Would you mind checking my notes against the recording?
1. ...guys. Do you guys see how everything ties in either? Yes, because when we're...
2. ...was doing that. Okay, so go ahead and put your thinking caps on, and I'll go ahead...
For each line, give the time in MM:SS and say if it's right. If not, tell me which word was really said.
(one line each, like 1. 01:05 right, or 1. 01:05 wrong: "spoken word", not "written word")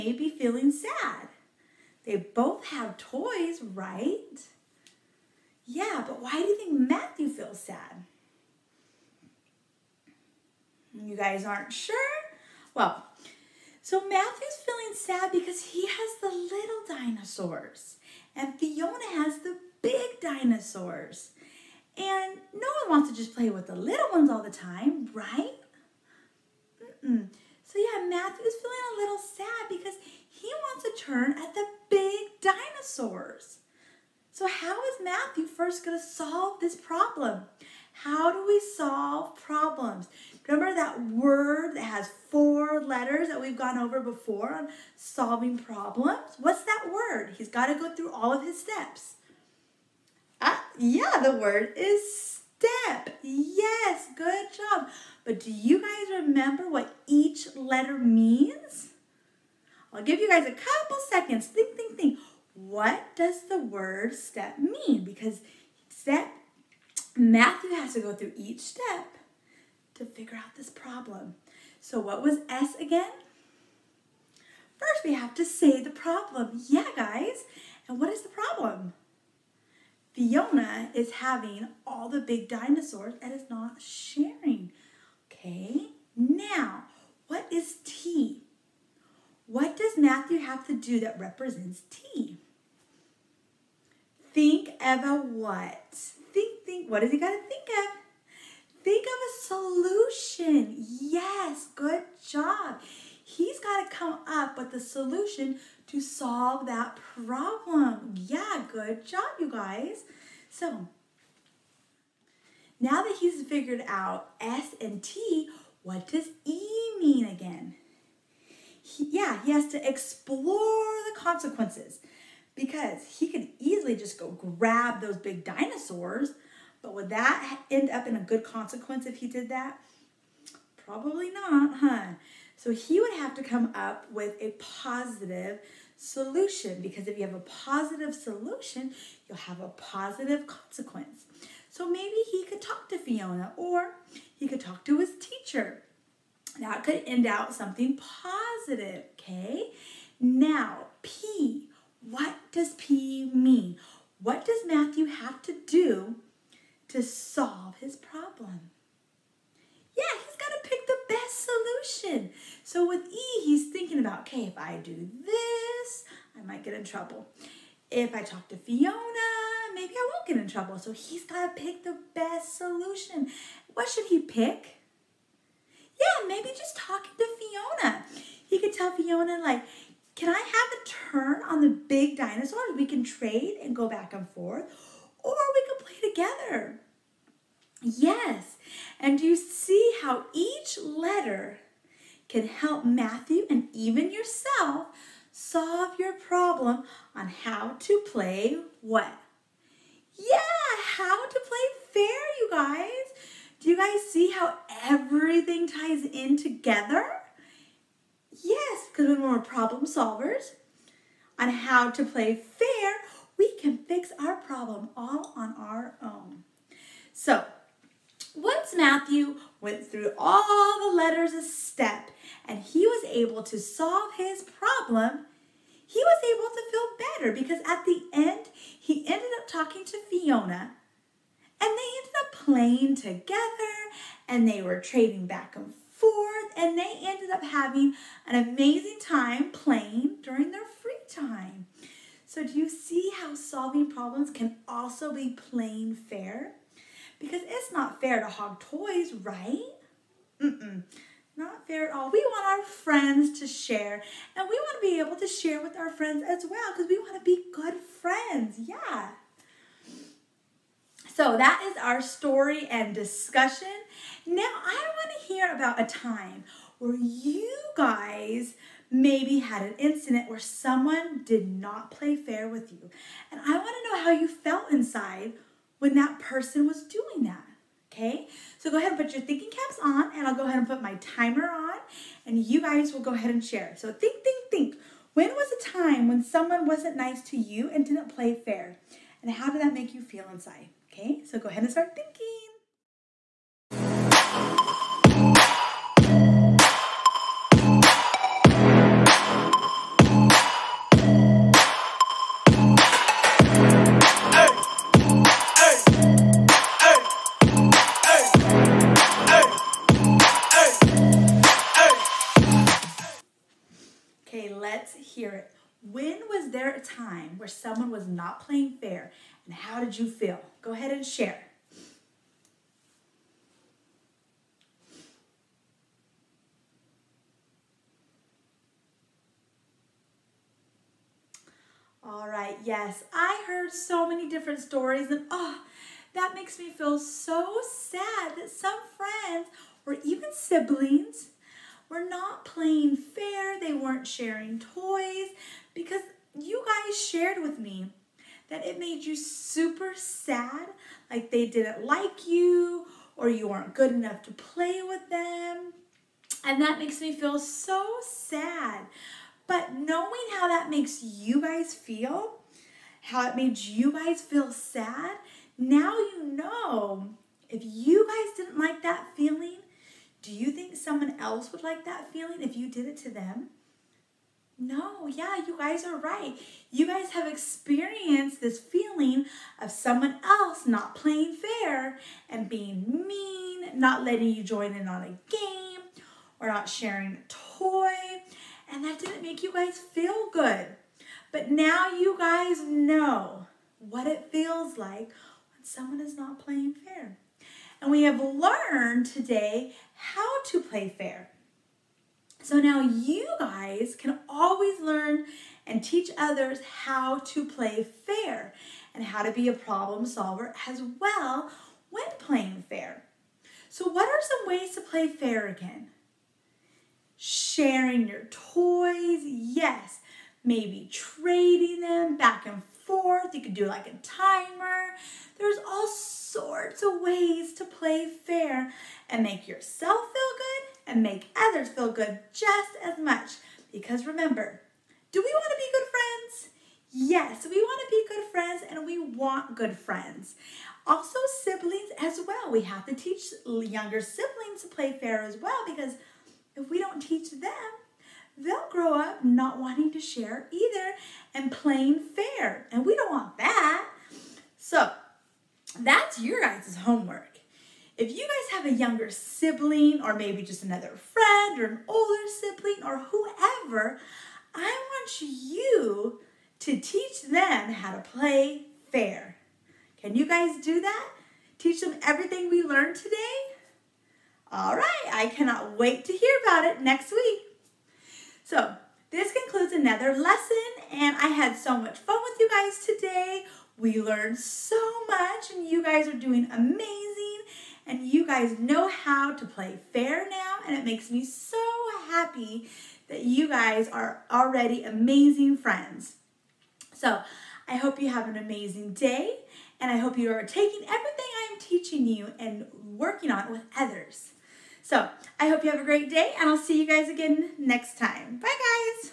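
1. 03:22 wrong: "together", not "either"
2. 04:36 right.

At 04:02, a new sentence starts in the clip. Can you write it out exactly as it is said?
So do you see how solving problems can also be plain fair?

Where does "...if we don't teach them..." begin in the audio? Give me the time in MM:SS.
07:26.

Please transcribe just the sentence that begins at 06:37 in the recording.
And we have learned today how to play fair.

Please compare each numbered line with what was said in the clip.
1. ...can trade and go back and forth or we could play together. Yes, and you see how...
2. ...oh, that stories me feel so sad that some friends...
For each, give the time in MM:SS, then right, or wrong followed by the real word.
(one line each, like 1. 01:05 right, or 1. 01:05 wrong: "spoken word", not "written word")
1. 03:02 right
2. 05:35 wrong: "makes", not "stories".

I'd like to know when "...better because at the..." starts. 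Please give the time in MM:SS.
03:47.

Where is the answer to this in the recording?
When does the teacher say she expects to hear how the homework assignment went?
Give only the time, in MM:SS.
07:56.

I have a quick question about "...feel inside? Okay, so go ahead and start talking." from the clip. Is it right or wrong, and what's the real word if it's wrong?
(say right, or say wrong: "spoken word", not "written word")
wrong: "thinking", not "talking".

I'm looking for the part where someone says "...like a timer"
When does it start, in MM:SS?
07:03.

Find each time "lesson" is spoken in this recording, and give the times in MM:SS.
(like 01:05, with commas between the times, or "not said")
08:00.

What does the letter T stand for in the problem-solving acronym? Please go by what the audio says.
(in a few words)
Think of a solution.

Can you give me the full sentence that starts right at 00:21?
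And no one wants to just play with the little ones all the time, right?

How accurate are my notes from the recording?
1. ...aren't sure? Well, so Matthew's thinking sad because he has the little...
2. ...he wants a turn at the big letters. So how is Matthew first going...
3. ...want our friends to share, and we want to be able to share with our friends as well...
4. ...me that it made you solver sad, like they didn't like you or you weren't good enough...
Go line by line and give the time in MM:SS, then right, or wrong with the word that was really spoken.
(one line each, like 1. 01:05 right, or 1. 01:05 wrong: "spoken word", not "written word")
1. 00:11 wrong: "feeling", not "thinking"
2. 00:30 wrong: "dinosaurs", not "letters"
3. 04:12 right
4. 05:47 wrong: "super", not "solver".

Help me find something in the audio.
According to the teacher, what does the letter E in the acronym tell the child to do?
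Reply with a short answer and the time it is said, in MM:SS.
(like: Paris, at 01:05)
Explore the consequences, at 01:59.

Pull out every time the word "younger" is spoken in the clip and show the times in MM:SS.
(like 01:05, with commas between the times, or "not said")
07:23, 07:38.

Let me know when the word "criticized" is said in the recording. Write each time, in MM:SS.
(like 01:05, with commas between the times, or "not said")
not said.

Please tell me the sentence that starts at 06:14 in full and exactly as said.
no, yeah, you guys are right.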